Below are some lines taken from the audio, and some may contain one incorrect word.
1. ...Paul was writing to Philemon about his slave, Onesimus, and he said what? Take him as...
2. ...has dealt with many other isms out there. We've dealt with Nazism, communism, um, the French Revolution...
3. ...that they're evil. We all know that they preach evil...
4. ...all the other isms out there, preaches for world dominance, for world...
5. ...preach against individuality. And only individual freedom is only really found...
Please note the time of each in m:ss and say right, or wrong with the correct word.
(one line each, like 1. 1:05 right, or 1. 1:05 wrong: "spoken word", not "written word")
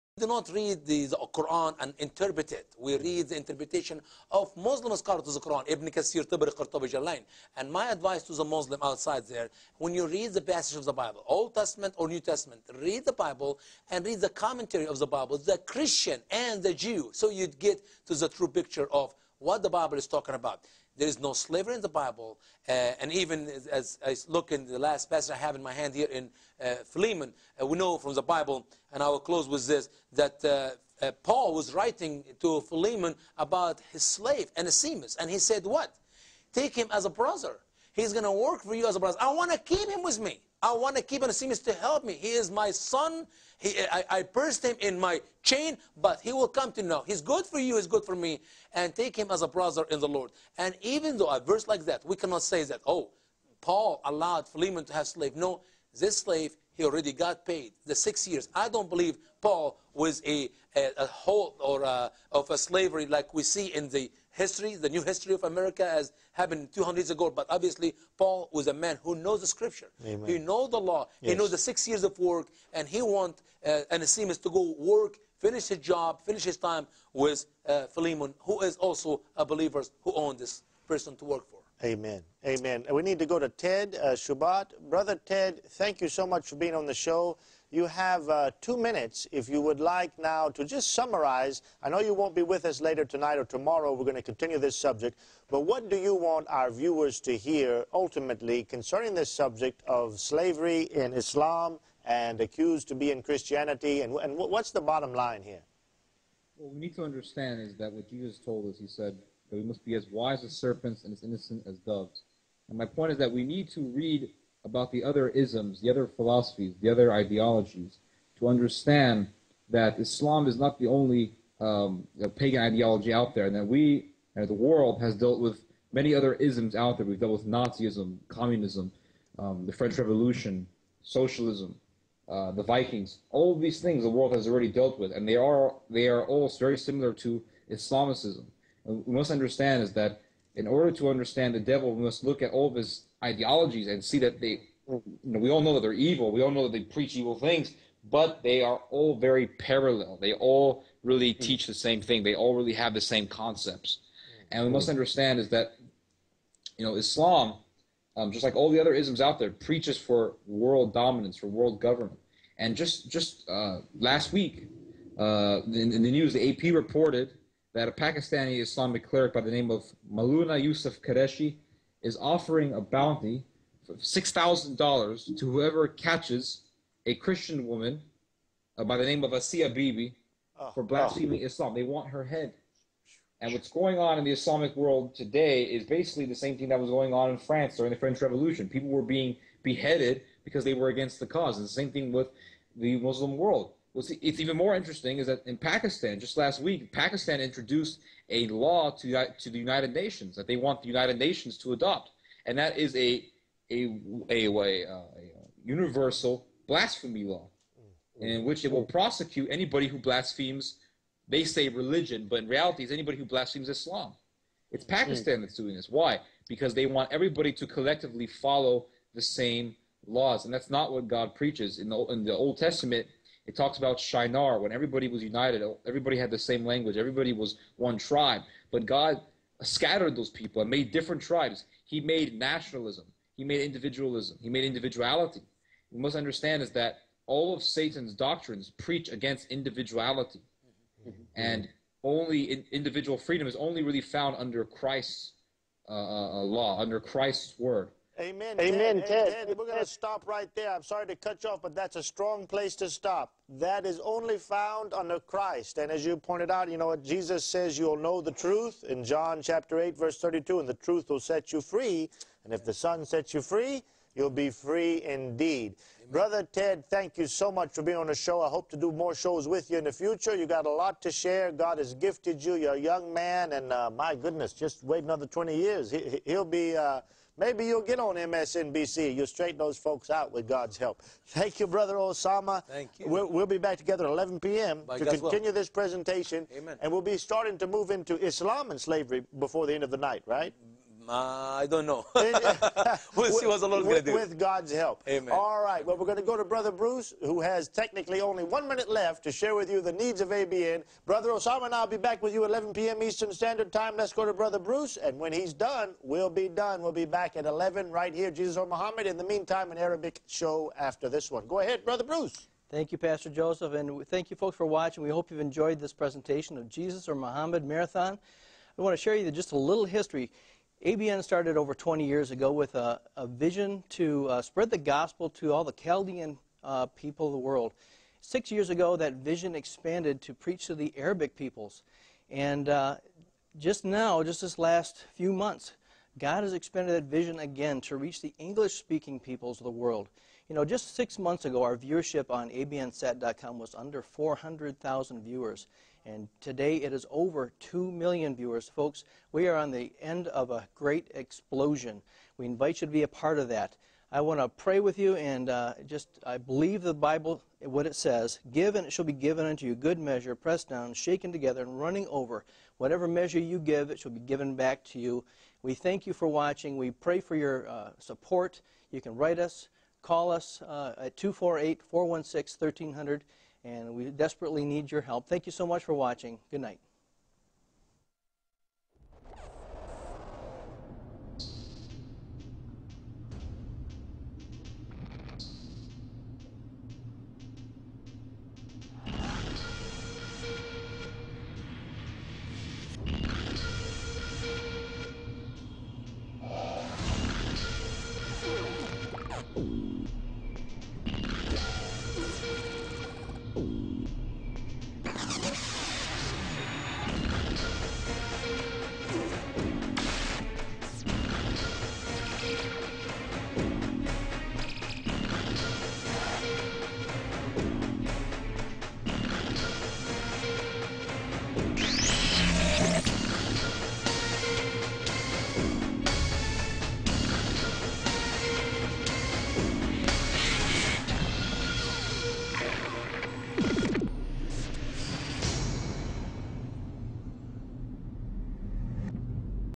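1. 0:31 right
2. 2:05 right
3. 2:25 right
4. 2:38 right
5. 3:58 right.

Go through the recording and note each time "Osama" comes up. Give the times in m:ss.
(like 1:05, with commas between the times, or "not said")
4:41, 5:01.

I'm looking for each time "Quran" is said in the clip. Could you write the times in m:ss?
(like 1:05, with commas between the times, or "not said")
0:01, 0:05.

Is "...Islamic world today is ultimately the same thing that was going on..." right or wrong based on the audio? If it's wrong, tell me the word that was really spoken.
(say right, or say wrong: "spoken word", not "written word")
wrong: "basically", not "ultimately".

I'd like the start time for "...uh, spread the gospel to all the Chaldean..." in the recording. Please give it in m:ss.
5:24.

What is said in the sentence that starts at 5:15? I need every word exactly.
We hope you've enjoyed this presentation of Jesus or Muhammad Marathon.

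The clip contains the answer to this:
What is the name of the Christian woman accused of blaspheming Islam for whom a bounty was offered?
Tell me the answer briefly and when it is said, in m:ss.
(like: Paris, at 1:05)
Asiya Bibi, at 2:59.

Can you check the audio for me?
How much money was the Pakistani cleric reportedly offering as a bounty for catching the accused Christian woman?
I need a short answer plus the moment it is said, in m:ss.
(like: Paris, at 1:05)
$6,000, at 2:53.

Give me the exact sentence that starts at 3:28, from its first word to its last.
in which it will prosecute anybody who blasphemes.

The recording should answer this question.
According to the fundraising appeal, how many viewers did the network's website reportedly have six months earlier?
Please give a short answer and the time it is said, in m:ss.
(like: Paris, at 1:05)
Under 400,000, at 5:43.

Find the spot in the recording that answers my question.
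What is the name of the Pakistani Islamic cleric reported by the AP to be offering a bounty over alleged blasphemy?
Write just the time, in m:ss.
2:50.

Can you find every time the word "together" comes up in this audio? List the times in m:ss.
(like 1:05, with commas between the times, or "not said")
4:43, 6:01.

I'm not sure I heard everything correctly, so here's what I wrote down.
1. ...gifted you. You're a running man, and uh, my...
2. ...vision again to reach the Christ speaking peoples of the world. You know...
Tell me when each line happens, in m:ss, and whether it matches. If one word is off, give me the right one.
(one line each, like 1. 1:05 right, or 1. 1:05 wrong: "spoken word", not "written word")
1. 4:31 wrong: "young", not "running"
2. 5:37 wrong: "English", not "Christ".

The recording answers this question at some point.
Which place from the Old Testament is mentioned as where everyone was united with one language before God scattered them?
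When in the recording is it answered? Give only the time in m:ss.
3:43.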